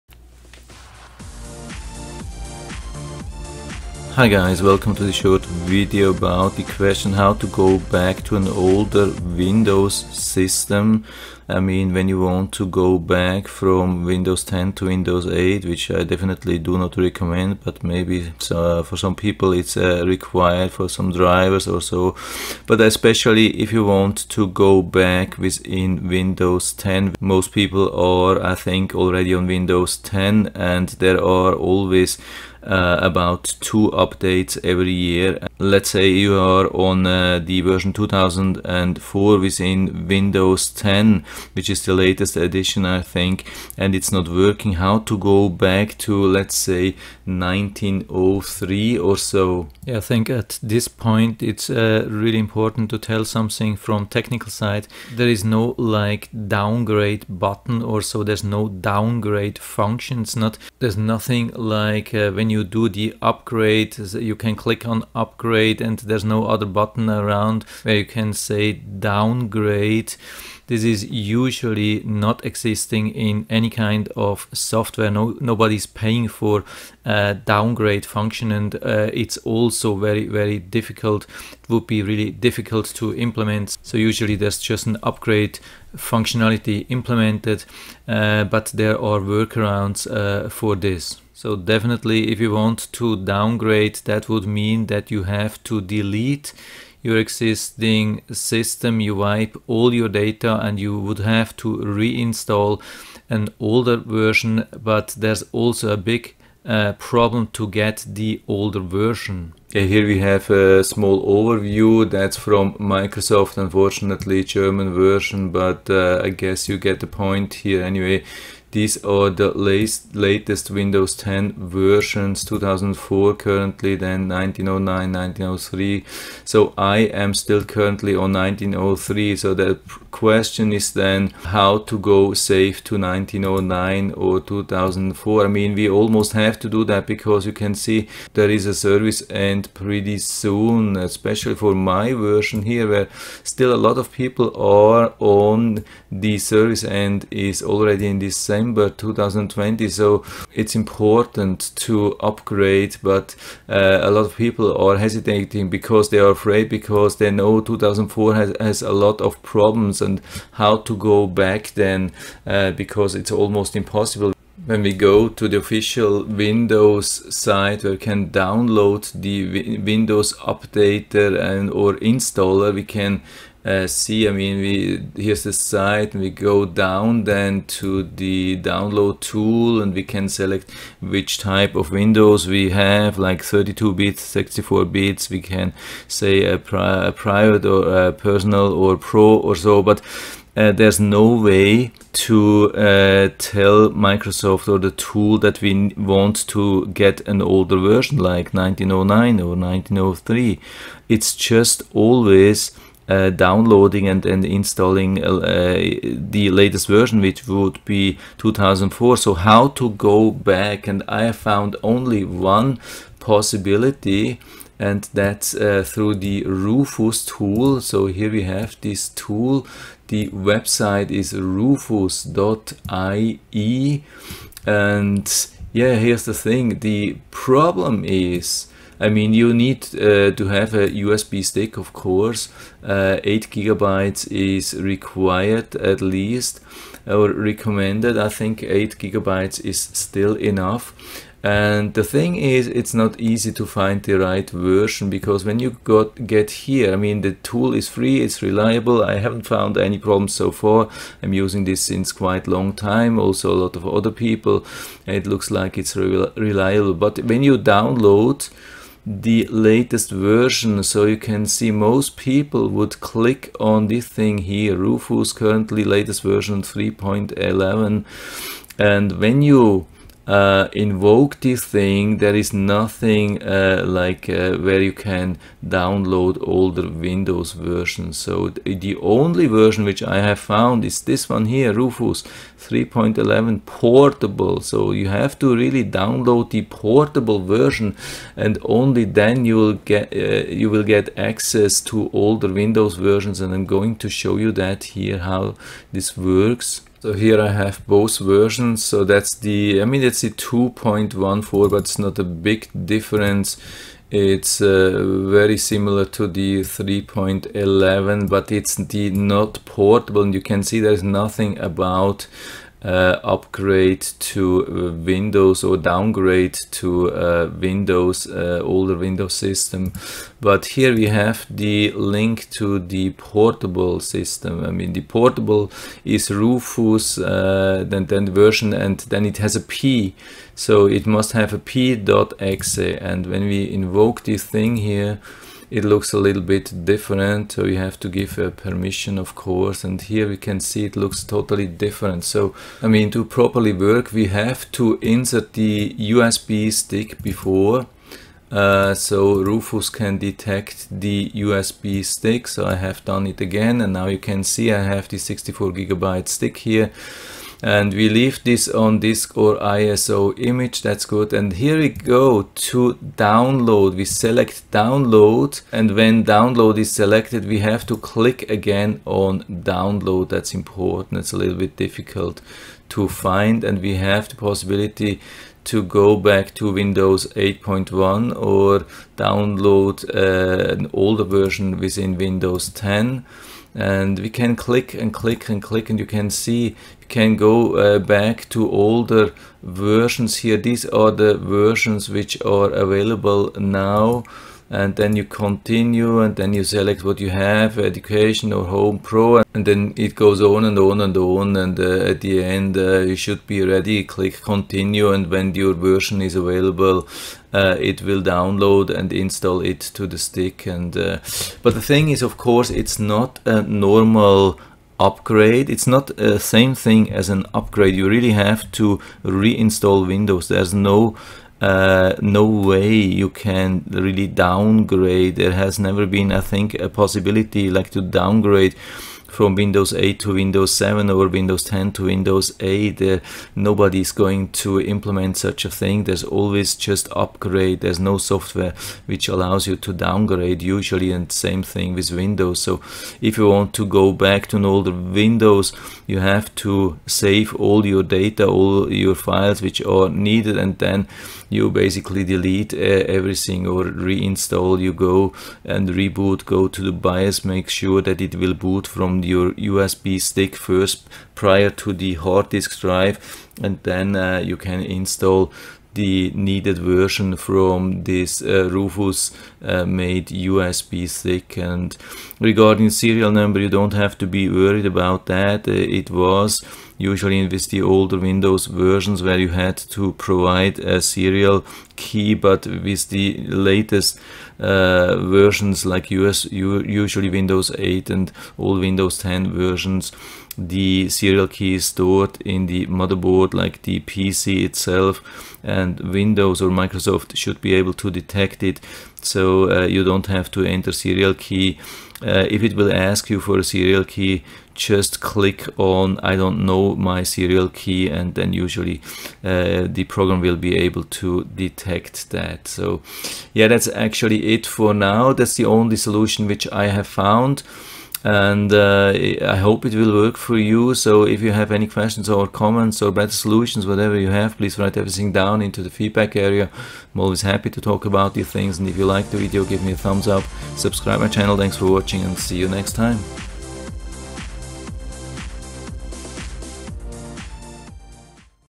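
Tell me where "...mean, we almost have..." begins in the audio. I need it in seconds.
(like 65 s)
135 s.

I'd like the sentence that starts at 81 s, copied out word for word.
It would be really difficult to implement.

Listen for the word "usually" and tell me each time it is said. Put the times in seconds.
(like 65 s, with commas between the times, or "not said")
71 s, 83 s, 440 s, 476 s, 486 s, 508 s.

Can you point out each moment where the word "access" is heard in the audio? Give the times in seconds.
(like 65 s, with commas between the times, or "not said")
291 s.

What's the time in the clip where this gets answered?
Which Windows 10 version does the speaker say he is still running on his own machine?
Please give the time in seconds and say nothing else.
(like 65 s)
126 s.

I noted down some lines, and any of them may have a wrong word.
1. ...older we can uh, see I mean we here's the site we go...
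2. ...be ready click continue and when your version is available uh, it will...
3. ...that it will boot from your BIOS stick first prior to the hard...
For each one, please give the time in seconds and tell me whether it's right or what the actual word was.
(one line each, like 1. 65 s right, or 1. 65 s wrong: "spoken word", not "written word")
1. 171 s wrong: "installer", not "older"
2. 403 s right
3. 458 s wrong: "USB", not "BIOS".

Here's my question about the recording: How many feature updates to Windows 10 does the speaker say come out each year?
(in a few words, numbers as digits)
2.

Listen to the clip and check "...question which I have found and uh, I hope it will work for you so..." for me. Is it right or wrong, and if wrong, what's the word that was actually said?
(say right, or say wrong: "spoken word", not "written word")
wrong: "solution", not "question".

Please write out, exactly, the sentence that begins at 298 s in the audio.
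So that's the, I mean, it's the 2.14, but it's not a big difference.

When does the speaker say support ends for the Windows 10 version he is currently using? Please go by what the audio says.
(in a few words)
December 2020.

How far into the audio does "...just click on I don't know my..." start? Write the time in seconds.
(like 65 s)
504 s.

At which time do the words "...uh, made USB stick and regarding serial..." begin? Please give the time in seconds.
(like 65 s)
469 s.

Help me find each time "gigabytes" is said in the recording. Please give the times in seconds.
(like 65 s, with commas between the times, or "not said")
233 s, 238 s, 355 s.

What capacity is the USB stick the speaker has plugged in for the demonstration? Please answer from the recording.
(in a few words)
64 GB.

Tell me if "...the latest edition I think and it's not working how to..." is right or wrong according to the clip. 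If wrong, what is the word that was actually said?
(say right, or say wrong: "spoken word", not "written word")
right.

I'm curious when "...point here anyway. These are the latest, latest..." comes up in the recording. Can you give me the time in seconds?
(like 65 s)
117 s.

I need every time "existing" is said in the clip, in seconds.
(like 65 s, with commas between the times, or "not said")
72 s, 97 s.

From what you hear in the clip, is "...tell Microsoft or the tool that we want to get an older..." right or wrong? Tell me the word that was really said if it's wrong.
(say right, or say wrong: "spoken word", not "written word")
right.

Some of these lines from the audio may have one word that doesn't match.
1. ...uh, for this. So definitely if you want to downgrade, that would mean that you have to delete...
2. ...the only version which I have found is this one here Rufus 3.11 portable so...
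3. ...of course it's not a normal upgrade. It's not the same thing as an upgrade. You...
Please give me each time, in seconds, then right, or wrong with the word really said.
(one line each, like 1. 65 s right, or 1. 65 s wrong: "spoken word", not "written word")
1. 90 s right
2. 278 s right
3. 412 s right.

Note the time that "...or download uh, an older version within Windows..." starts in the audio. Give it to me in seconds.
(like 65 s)
378 s.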